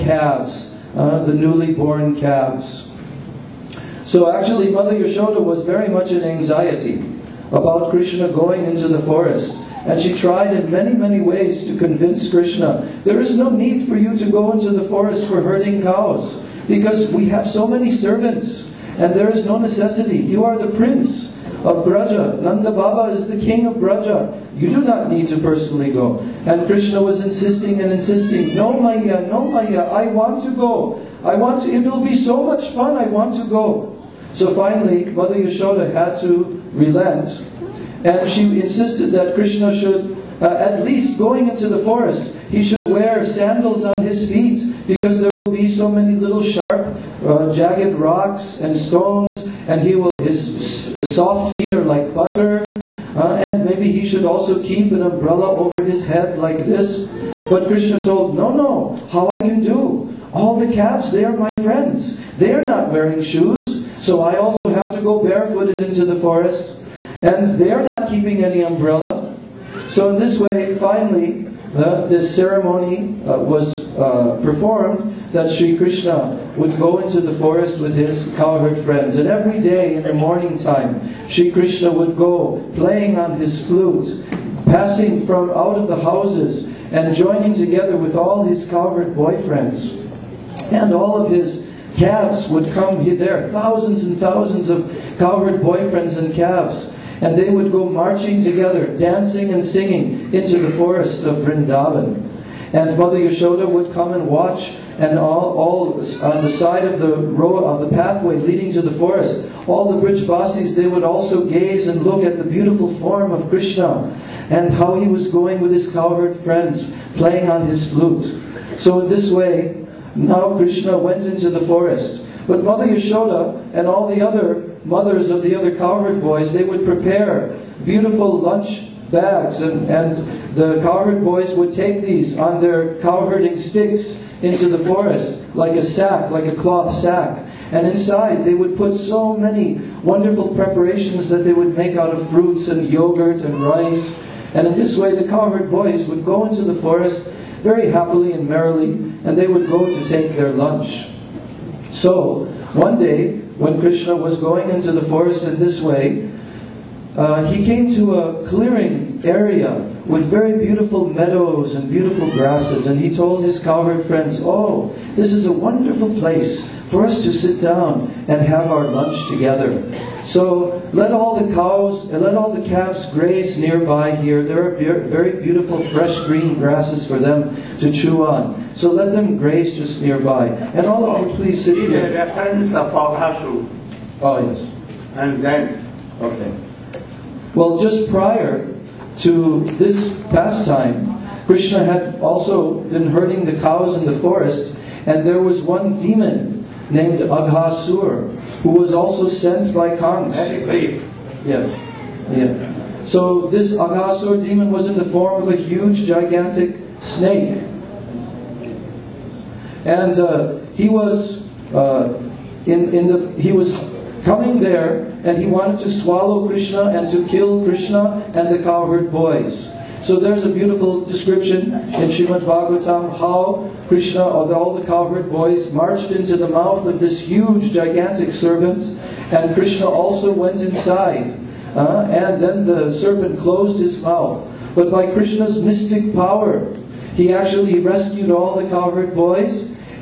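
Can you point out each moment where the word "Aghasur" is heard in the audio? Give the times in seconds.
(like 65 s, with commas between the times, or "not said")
197 s, 203 s.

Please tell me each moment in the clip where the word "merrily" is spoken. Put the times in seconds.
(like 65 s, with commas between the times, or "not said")
148 s.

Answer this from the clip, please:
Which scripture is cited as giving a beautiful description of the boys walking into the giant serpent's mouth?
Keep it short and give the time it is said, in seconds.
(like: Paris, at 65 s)
Shrimad Bhagavatam, at 222 s.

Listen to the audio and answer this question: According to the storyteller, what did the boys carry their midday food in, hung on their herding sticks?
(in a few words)
Cloth sack.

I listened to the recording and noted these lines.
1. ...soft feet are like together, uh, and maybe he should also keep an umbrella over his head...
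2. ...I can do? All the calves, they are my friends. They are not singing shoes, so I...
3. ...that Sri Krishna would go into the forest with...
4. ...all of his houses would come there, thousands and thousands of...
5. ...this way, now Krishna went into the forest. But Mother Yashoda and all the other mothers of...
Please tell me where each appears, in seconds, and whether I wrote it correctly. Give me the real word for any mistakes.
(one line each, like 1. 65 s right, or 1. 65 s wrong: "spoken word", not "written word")
1. 51 s wrong: "butter", not "together"
2. 59 s wrong: "wearing", not "singing"
3. 75 s right
4. 90 s wrong: "calves", not "houses"
5. 119 s right.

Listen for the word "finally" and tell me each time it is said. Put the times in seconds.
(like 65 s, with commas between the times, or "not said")
34 s, 70 s.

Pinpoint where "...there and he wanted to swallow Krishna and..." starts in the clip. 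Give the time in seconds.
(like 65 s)
214 s.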